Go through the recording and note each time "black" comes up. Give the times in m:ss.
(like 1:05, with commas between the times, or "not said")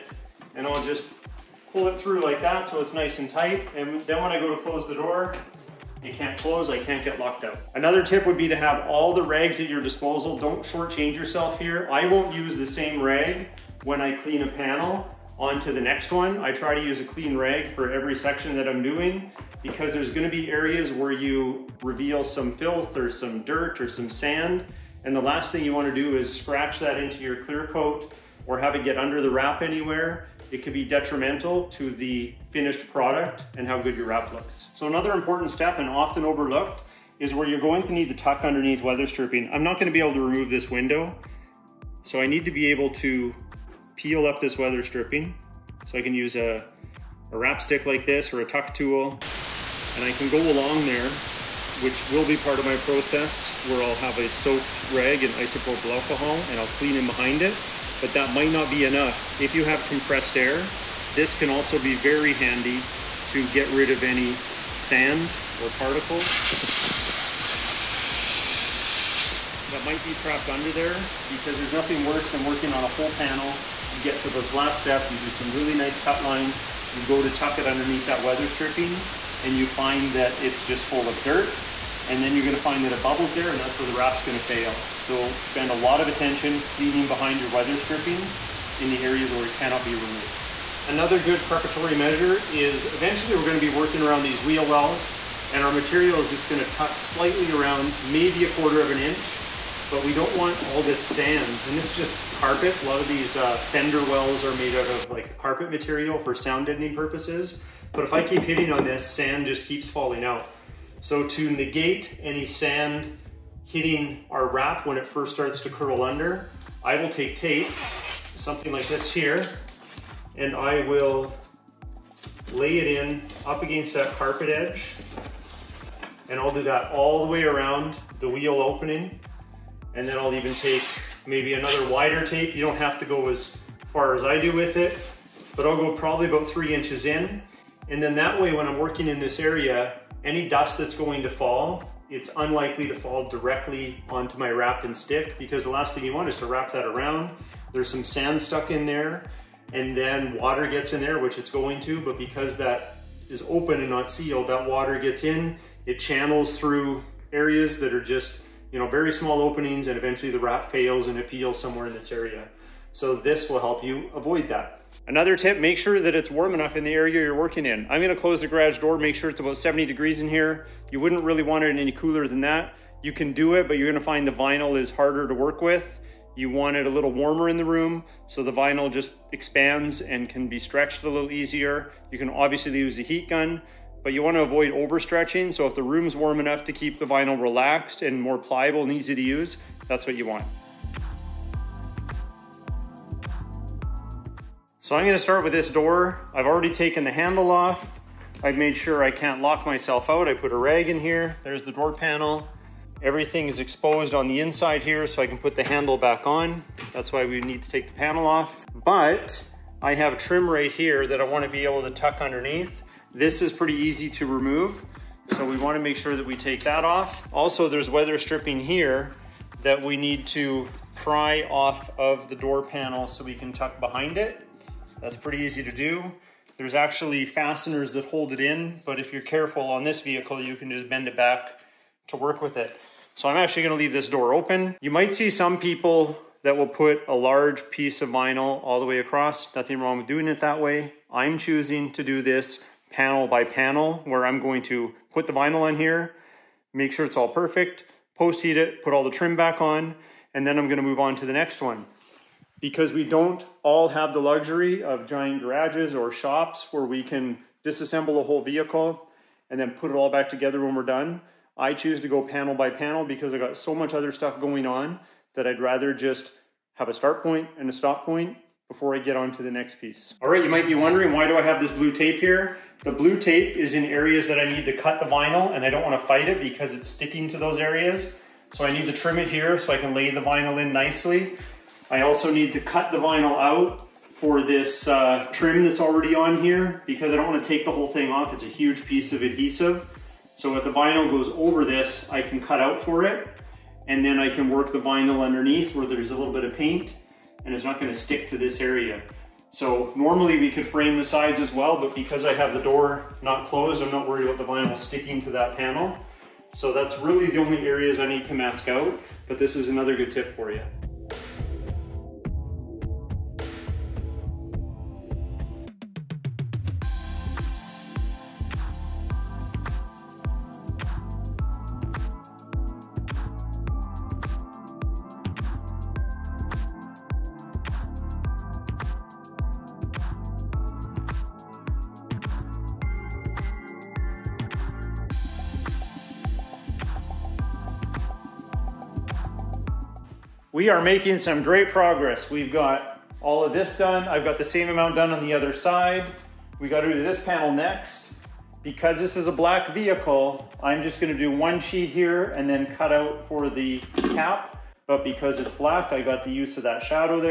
5:49, 5:55.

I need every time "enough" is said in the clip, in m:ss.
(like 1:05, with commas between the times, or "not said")
0:58, 2:46, 3:06.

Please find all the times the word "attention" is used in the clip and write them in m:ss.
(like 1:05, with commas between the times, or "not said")
1:26.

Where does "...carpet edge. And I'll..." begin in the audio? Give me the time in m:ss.
2:04.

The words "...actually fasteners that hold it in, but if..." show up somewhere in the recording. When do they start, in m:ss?
3:46.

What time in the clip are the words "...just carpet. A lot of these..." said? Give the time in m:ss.
1:41.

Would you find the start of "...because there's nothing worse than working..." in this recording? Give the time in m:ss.
1:11.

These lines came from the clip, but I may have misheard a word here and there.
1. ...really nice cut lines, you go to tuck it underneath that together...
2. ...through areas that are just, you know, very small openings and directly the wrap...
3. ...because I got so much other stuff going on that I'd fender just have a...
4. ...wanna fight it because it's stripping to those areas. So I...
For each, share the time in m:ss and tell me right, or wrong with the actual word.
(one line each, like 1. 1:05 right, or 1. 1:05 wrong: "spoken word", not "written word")
1. 1:15 wrong: "weather", not "together"
2. 2:36 wrong: "eventually", not "directly"
3. 4:23 wrong: "rather", not "fender"
4. 4:35 wrong: "sticking", not "stripping".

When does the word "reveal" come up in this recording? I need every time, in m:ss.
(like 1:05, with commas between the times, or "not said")
0:21.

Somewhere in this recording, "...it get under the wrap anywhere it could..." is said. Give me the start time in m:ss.
0:28.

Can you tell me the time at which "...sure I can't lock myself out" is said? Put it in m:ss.
3:18.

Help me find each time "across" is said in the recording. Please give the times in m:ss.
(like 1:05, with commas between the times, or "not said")
3:58.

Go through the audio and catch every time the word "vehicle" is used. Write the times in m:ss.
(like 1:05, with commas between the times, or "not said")
3:49, 4:18, 5:49.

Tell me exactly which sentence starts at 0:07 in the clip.
Another tip would be to have all the rags at your disposal.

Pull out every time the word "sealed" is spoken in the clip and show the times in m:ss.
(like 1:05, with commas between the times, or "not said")
2:34.